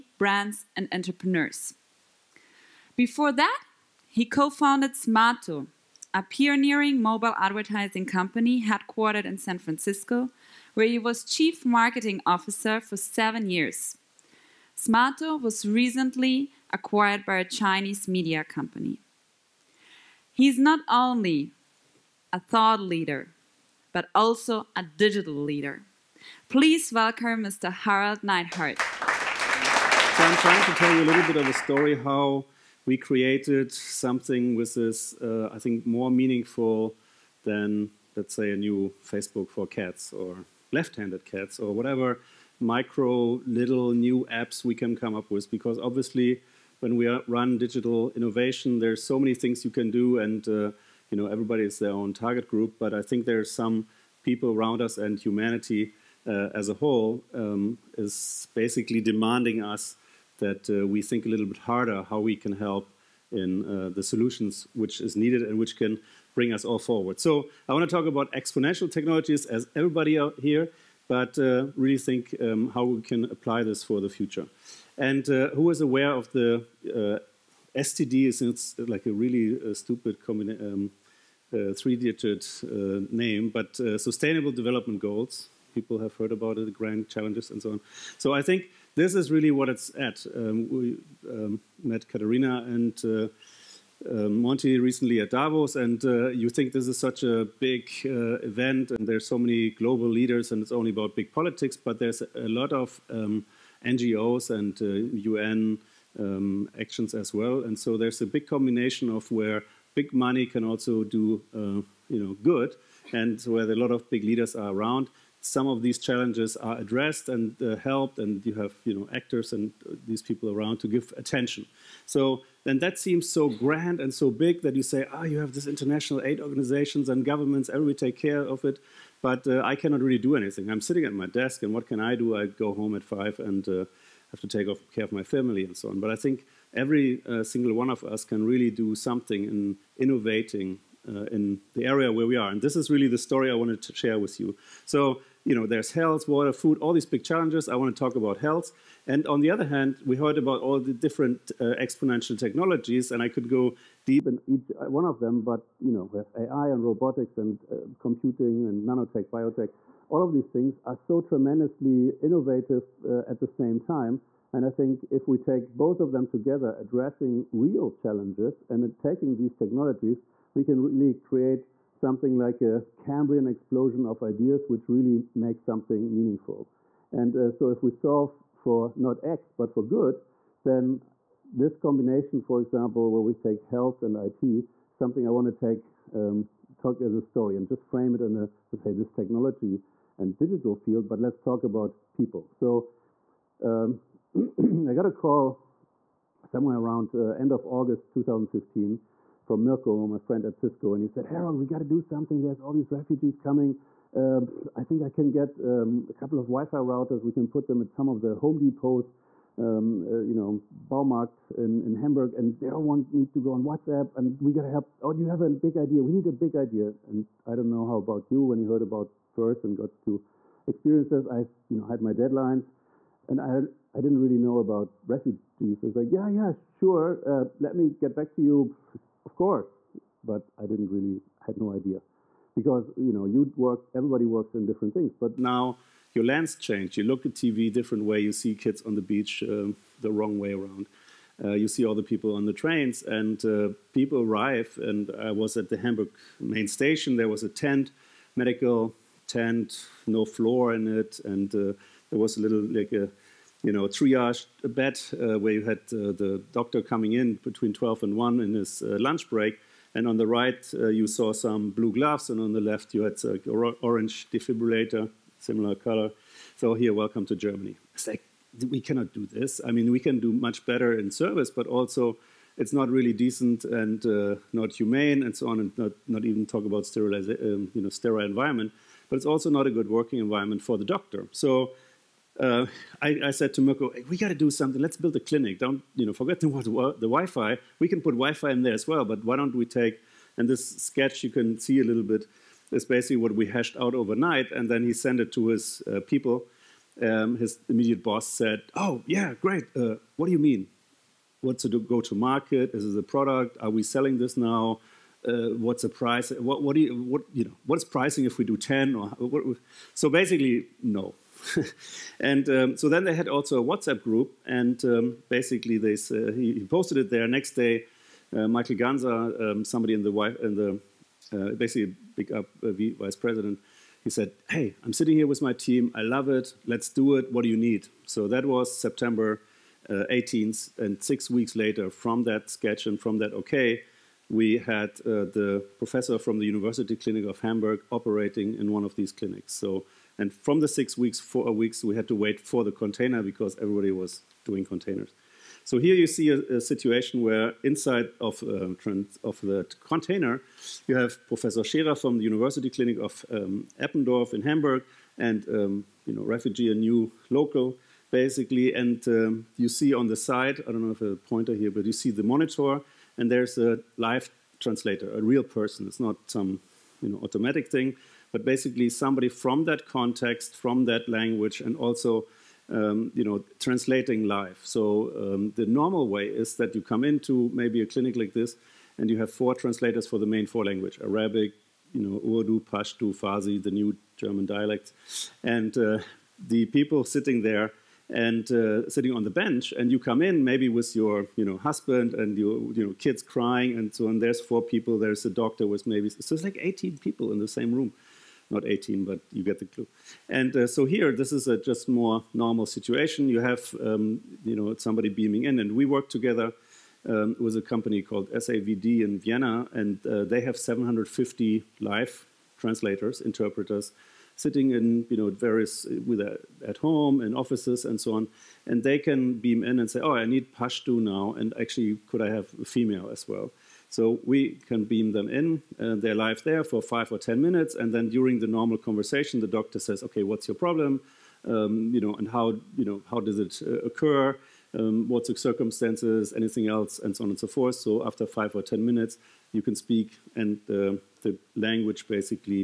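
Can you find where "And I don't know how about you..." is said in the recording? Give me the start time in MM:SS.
03:37.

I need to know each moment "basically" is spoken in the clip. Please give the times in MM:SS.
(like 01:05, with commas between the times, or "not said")
00:58, 04:52, 05:10, 05:15, 05:21, 05:58, 06:08, 07:22.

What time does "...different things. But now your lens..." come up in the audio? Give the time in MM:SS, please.
03:54.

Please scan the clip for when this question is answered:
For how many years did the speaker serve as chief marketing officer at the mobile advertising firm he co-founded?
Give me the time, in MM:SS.
00:12.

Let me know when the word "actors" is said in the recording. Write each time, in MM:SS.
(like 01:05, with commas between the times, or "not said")
01:59.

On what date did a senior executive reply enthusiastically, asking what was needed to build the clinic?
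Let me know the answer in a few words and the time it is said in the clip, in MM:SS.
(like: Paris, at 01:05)
September 18, at 05:28.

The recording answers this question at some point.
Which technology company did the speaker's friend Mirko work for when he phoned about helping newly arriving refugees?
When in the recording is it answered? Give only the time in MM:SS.
03:20.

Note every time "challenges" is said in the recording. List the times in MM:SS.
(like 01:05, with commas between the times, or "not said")
01:27, 01:55, 02:27, 02:47.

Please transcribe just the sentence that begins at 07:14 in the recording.
Um, what's the circumstances, anything else, and so on and so forth.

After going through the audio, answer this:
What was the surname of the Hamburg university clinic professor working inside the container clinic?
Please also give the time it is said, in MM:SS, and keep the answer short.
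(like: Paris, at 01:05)
Scherer, at 05:51.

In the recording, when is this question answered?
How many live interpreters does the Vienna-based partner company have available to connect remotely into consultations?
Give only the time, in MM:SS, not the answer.
06:50.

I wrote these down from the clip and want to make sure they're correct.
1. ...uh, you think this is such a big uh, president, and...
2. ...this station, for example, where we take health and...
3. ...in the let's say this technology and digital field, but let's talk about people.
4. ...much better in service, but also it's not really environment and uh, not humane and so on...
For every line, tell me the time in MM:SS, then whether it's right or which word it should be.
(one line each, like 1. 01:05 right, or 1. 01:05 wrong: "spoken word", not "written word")
1. 01:36 wrong: "event", not "president"
2. 03:01 wrong: "combination", not "station"
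3. 03:08 right
4. 04:30 wrong: "decent", not "environment".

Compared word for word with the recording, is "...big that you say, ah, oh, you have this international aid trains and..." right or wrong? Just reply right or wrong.
wrong.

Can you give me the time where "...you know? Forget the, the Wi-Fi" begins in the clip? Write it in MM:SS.
04:45.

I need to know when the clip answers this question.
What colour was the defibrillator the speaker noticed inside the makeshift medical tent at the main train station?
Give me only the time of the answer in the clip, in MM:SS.
04:23.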